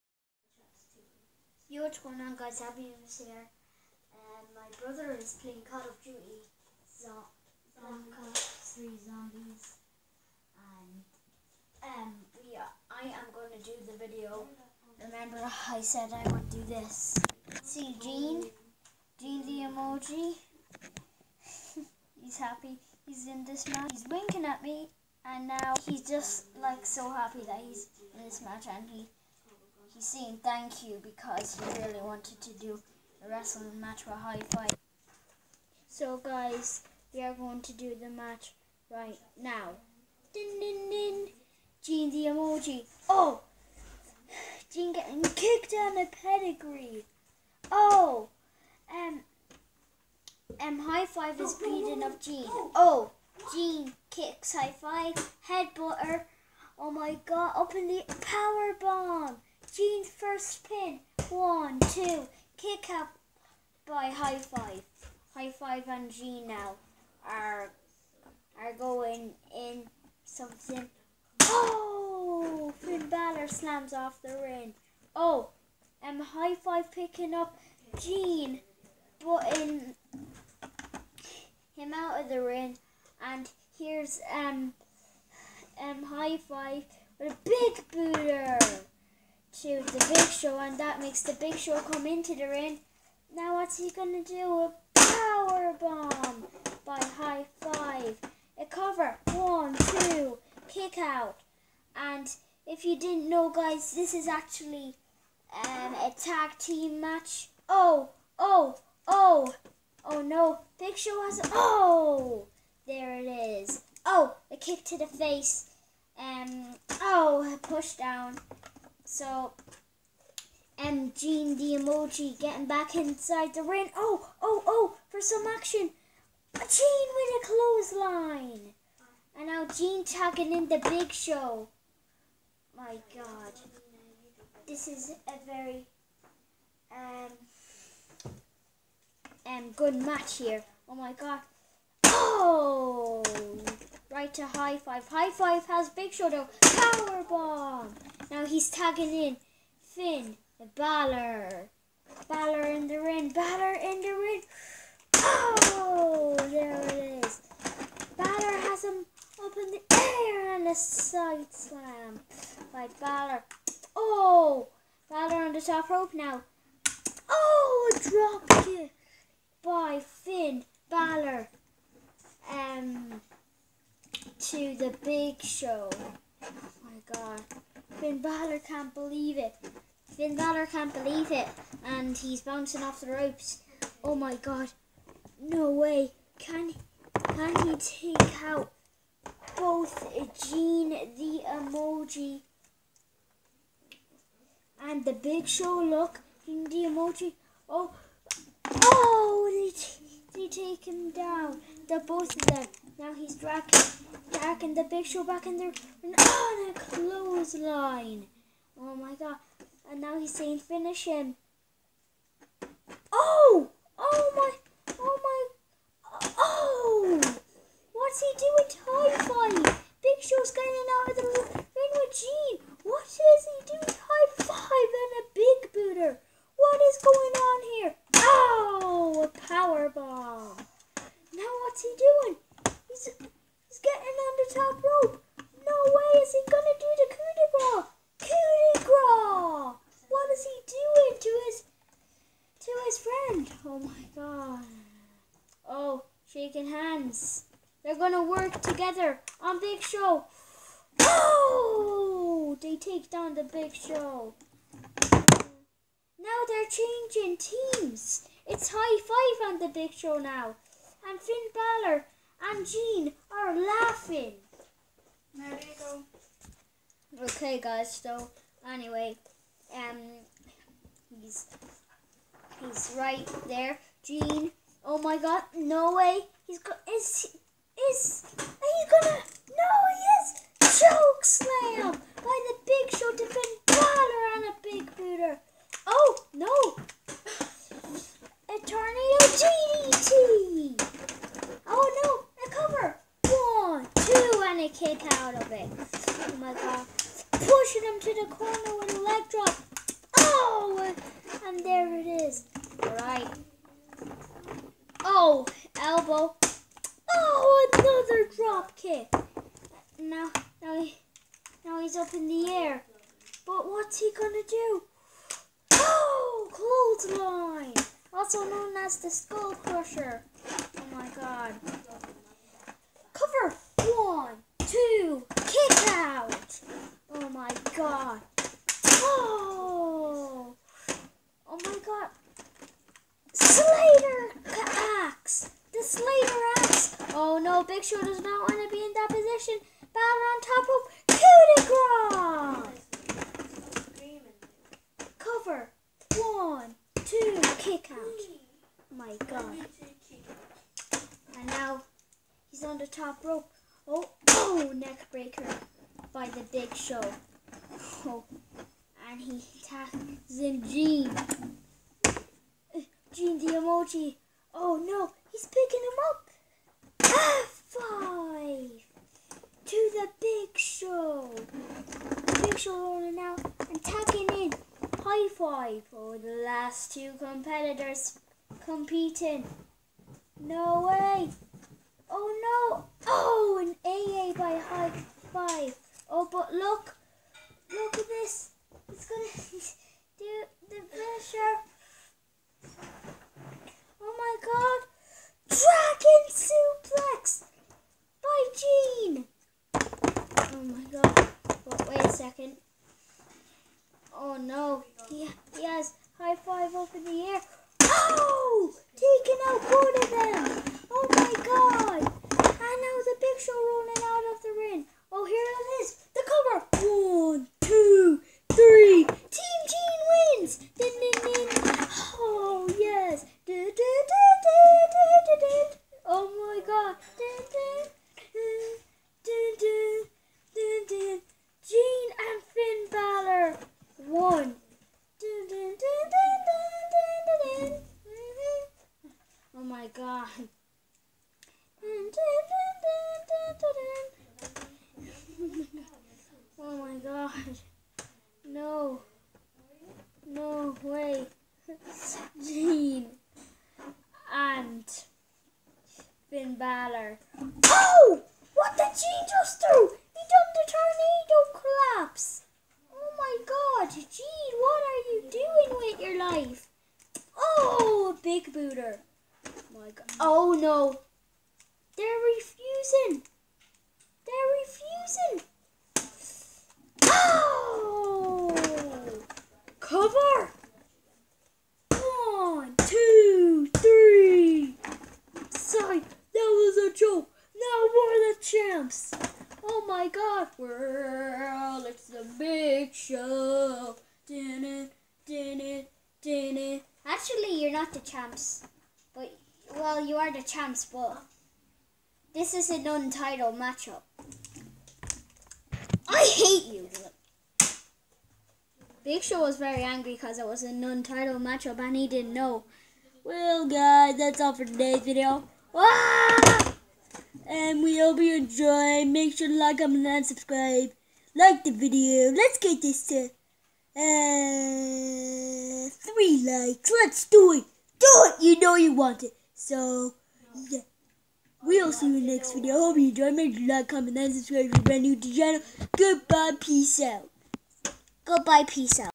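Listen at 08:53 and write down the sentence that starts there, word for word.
Make sure you like, comment, and subscribe if you're brand new to the channel.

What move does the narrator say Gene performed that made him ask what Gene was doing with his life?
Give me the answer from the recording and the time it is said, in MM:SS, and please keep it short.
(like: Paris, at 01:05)
tornado collapse, at 07:40.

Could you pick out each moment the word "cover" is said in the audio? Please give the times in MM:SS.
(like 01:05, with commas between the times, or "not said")
01:38, 05:45, 07:59.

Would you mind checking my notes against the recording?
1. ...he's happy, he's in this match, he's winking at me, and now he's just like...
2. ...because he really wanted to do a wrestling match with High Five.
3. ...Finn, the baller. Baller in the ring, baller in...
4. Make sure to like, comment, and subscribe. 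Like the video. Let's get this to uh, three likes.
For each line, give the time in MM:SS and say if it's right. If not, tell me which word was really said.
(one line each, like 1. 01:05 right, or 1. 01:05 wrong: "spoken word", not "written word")
1. 00:22 right
2. 00:31 right
3. 02:29 right
4. 08:39 right.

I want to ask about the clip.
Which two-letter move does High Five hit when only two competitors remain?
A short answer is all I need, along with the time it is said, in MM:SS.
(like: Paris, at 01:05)
AA, at 06:23.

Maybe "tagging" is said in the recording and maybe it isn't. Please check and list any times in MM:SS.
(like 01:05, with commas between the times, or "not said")
02:10, 02:28, 06:13.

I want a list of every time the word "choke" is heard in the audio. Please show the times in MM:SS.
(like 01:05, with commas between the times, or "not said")
04:40.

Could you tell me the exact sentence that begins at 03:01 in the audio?
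And he's bouncing off the ropes.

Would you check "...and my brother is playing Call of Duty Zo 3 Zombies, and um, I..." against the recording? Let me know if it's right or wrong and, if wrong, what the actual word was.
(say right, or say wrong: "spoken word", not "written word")
right.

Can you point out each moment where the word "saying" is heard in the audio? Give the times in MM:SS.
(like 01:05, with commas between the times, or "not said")
00:30, 03:30.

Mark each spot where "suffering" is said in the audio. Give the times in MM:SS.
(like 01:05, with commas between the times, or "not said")
not said.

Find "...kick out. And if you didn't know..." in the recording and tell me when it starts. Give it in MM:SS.
01:40.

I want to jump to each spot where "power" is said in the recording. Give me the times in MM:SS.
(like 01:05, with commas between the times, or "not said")
00:58, 01:34, 02:26.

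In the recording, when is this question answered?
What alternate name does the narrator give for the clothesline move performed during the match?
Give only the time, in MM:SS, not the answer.
05:19.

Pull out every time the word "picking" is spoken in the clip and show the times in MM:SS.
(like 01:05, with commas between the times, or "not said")
01:16, 06:05.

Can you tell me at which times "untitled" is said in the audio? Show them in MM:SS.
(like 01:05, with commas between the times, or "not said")
08:22, 08:30.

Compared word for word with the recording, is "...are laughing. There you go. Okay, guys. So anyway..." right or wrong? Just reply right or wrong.
right.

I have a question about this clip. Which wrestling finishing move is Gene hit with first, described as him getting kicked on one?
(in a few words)
pedigree.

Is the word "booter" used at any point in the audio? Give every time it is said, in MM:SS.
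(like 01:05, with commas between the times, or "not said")
01:27, 04:44, 07:48.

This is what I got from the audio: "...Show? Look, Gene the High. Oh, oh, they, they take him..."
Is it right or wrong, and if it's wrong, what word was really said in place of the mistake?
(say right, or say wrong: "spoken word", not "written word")
wrong: "Emoji", not "High".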